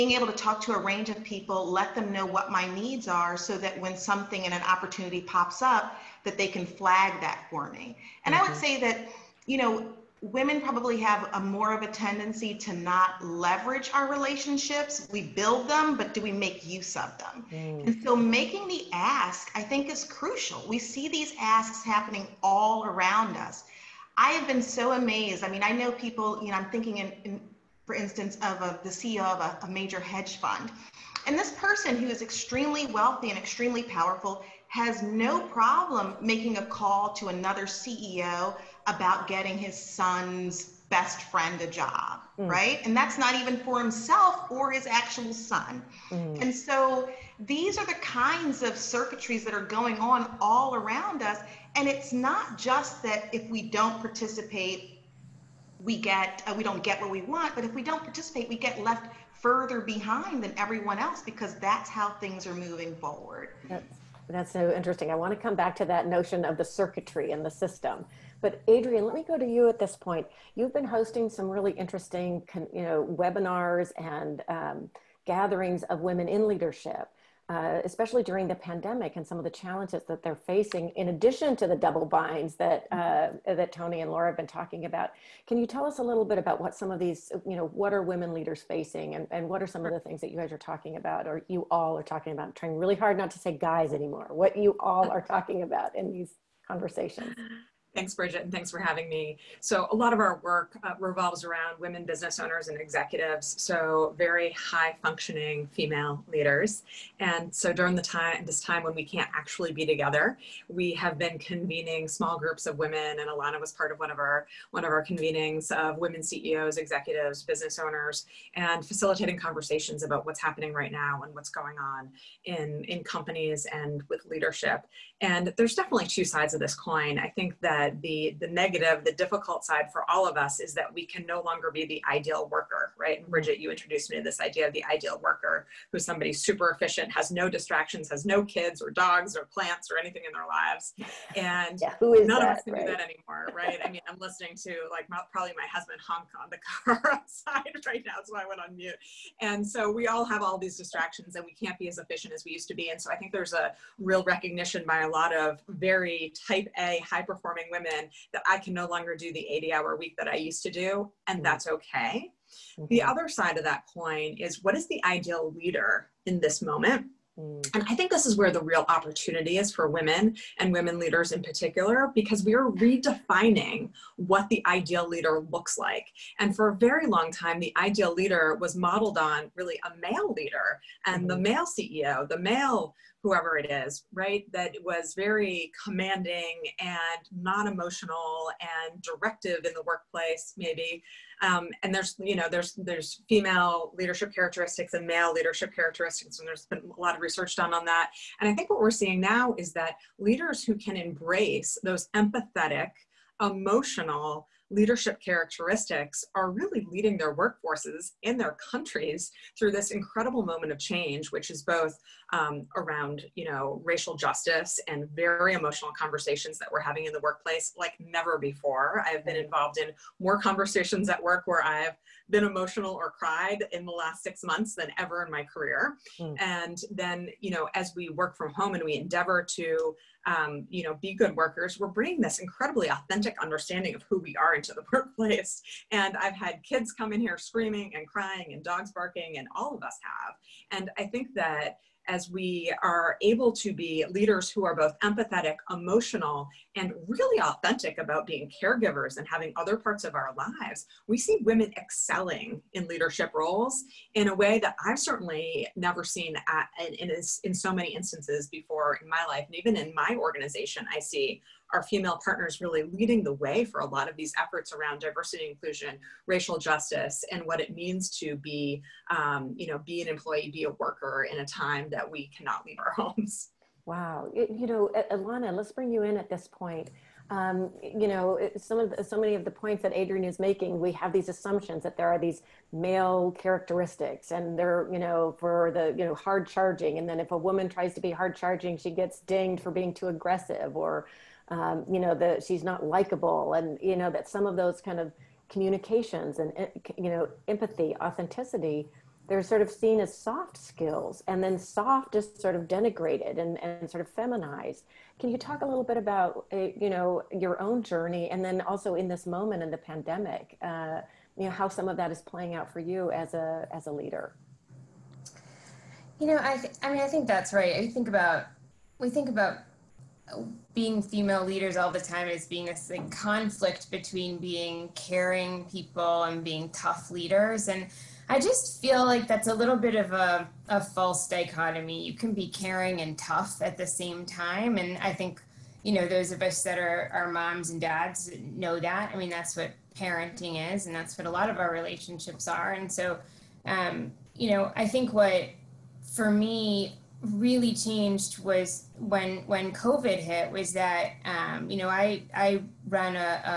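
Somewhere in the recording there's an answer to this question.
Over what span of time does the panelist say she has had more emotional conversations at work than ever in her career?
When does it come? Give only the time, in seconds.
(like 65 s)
224 s.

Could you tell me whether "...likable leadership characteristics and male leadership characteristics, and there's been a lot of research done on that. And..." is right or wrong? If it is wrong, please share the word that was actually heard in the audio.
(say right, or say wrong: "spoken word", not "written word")
wrong: "female", not "likable".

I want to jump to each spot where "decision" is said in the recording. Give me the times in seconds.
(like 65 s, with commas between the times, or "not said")
not said.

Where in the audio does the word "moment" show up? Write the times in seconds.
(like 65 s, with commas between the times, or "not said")
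166 s, 210 s, 309 s.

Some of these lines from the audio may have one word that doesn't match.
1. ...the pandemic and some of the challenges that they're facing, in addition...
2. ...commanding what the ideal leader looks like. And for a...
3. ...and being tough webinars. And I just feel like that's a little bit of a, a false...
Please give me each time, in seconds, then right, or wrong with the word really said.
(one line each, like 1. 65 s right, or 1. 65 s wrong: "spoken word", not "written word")
1. 78 s right
2. 172 s wrong: "redefining", not "commanding"
3. 326 s wrong: "leaders", not "webinars".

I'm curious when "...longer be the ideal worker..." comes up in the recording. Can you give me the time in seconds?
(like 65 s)
131 s.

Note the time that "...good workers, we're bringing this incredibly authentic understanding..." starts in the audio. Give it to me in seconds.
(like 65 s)
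231 s.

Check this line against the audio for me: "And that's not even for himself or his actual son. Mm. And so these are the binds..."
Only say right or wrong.
wrong.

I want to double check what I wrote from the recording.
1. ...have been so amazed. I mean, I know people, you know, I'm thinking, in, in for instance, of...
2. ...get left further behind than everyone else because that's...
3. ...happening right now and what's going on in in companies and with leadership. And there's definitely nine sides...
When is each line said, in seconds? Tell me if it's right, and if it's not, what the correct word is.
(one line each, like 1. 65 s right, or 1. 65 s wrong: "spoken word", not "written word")
1. 24 s right
2. 58 s right
3. 120 s wrong: "two", not "nine".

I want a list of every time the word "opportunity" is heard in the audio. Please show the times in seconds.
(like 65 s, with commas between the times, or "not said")
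4 s, 168 s.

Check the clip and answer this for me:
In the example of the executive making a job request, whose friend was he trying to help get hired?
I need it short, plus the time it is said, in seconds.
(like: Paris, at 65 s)
his son's best friend, at 39 s.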